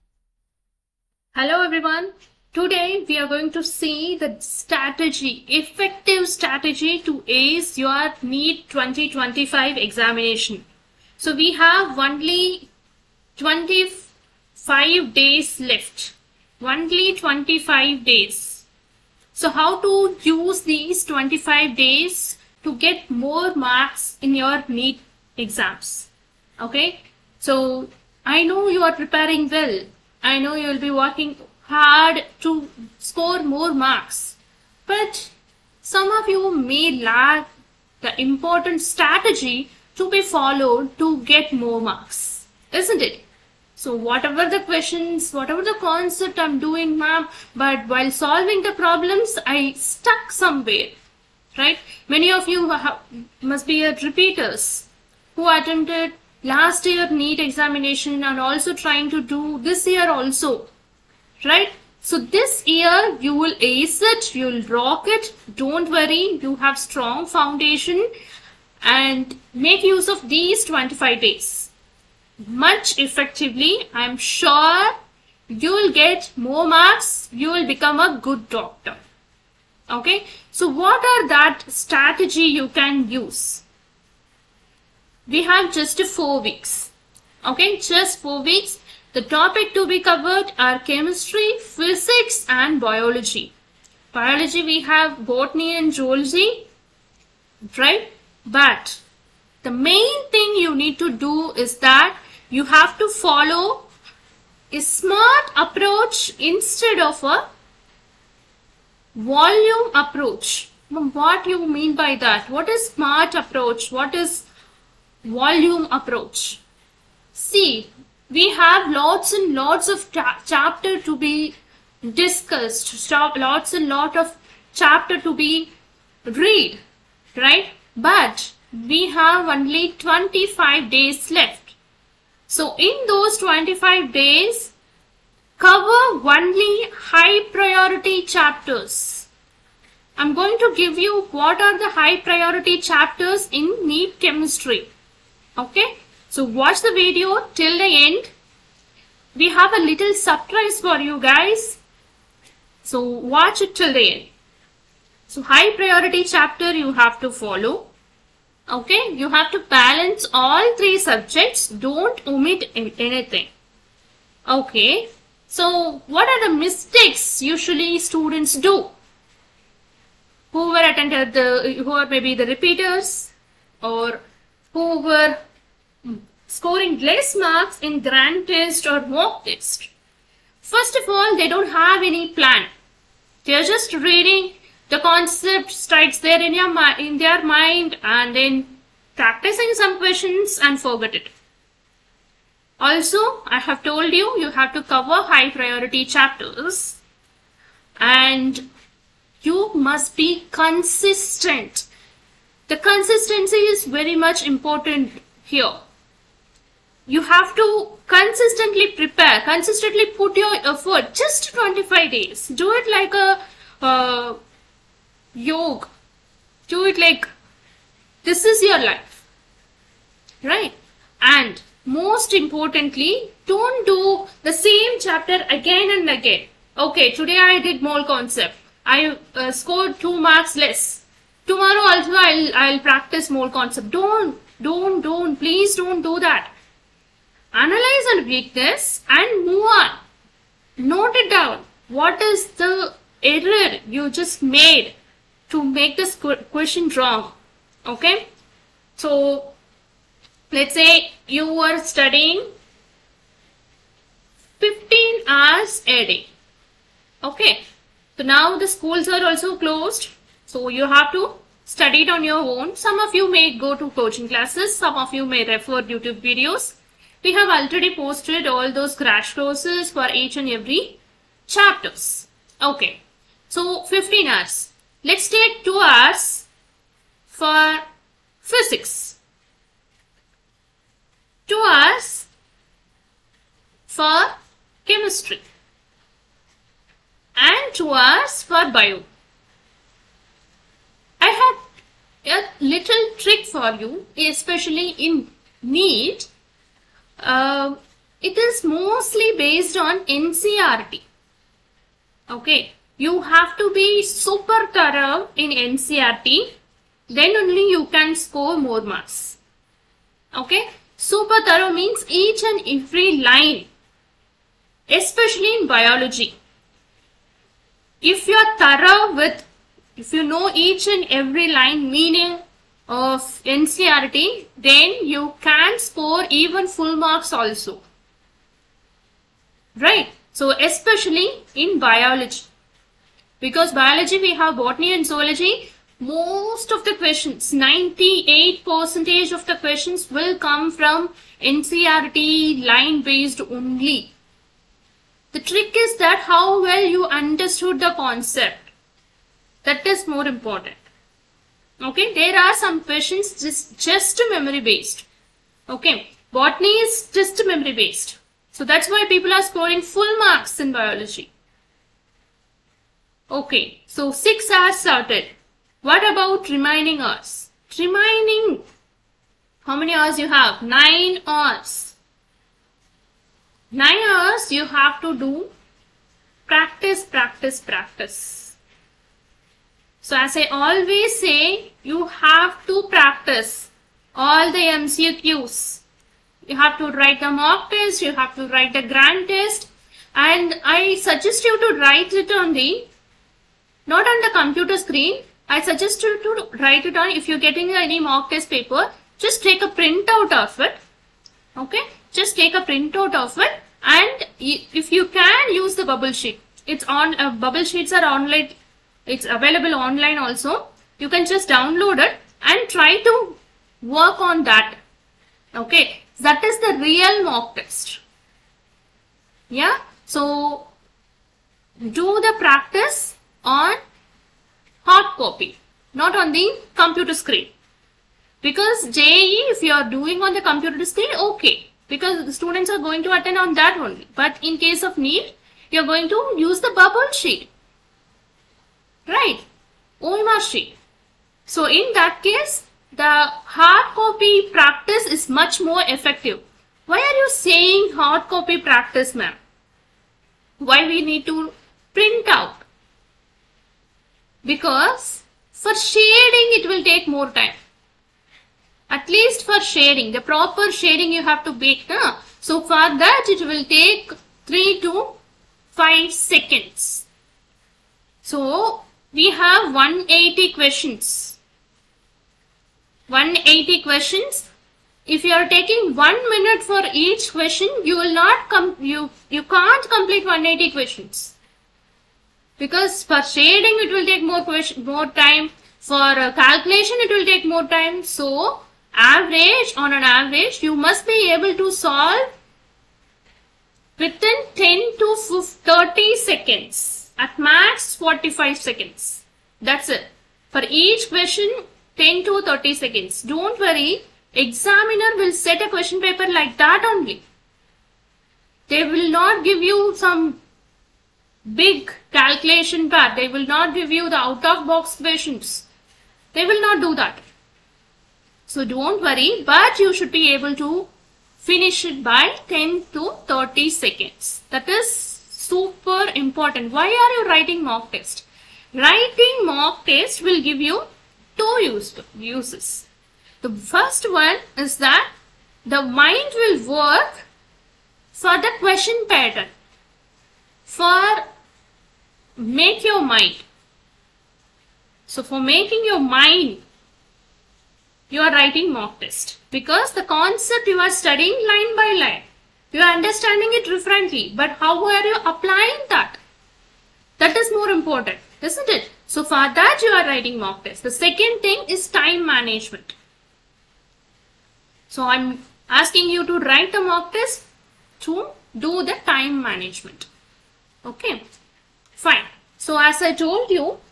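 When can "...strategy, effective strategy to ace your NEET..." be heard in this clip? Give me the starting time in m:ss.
0:04.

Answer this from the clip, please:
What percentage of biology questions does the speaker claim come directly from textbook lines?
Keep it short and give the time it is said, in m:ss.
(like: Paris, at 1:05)
98%, at 5:37.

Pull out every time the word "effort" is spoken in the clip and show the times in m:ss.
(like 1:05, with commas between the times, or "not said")
3:30.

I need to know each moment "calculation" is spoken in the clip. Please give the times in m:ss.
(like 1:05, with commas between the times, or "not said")
8:06, 8:32.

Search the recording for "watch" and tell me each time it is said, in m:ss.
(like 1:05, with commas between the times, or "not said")
2:26, 2:33.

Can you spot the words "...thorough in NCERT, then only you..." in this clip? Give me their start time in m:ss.
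5:04.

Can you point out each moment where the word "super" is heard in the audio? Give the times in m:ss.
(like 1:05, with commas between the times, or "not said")
5:04, 5:10, 8:45.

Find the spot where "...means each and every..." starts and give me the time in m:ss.
5:11.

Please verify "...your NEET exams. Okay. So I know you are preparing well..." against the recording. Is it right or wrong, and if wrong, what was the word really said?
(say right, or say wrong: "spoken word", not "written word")
right.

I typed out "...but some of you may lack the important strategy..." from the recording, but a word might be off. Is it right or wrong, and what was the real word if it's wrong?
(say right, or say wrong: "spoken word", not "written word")
right.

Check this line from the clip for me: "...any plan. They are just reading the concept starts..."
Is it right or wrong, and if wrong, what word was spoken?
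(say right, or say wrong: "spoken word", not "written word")
right.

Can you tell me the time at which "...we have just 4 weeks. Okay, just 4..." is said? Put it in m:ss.
1:25.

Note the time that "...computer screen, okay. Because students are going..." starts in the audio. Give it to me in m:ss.
7:10.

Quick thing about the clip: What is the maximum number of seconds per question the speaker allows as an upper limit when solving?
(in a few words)
45.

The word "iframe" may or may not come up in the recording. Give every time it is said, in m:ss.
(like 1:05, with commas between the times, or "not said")
not said.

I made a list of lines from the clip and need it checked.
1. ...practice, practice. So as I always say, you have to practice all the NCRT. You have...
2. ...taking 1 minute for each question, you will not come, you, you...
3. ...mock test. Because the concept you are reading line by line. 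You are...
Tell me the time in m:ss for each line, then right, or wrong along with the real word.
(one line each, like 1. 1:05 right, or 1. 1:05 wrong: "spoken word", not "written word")
1. 6:17 wrong: "MCQs", not "NCRT"
2. 7:55 right
3. 9:08 wrong: "studying", not "reading".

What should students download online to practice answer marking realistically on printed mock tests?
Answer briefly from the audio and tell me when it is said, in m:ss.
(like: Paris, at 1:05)
bubble sheets, at 6:47.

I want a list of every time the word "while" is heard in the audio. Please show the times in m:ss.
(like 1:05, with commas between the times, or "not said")
0:47.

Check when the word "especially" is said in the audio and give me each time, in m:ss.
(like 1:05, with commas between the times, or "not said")
4:54, 5:14, 5:30.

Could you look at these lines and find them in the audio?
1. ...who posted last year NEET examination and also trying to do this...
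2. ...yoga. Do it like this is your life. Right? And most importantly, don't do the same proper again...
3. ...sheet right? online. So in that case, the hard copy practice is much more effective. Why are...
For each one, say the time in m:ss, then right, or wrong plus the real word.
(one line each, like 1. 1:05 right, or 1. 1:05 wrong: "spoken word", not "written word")
1. 0:55 wrong: "attempted", not "posted"
2. 3:35 wrong: "chapter", not "proper"
3. 7:17 wrong: "machine", not "online".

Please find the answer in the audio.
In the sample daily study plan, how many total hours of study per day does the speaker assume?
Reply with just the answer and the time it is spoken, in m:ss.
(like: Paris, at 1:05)
15, at 4:14.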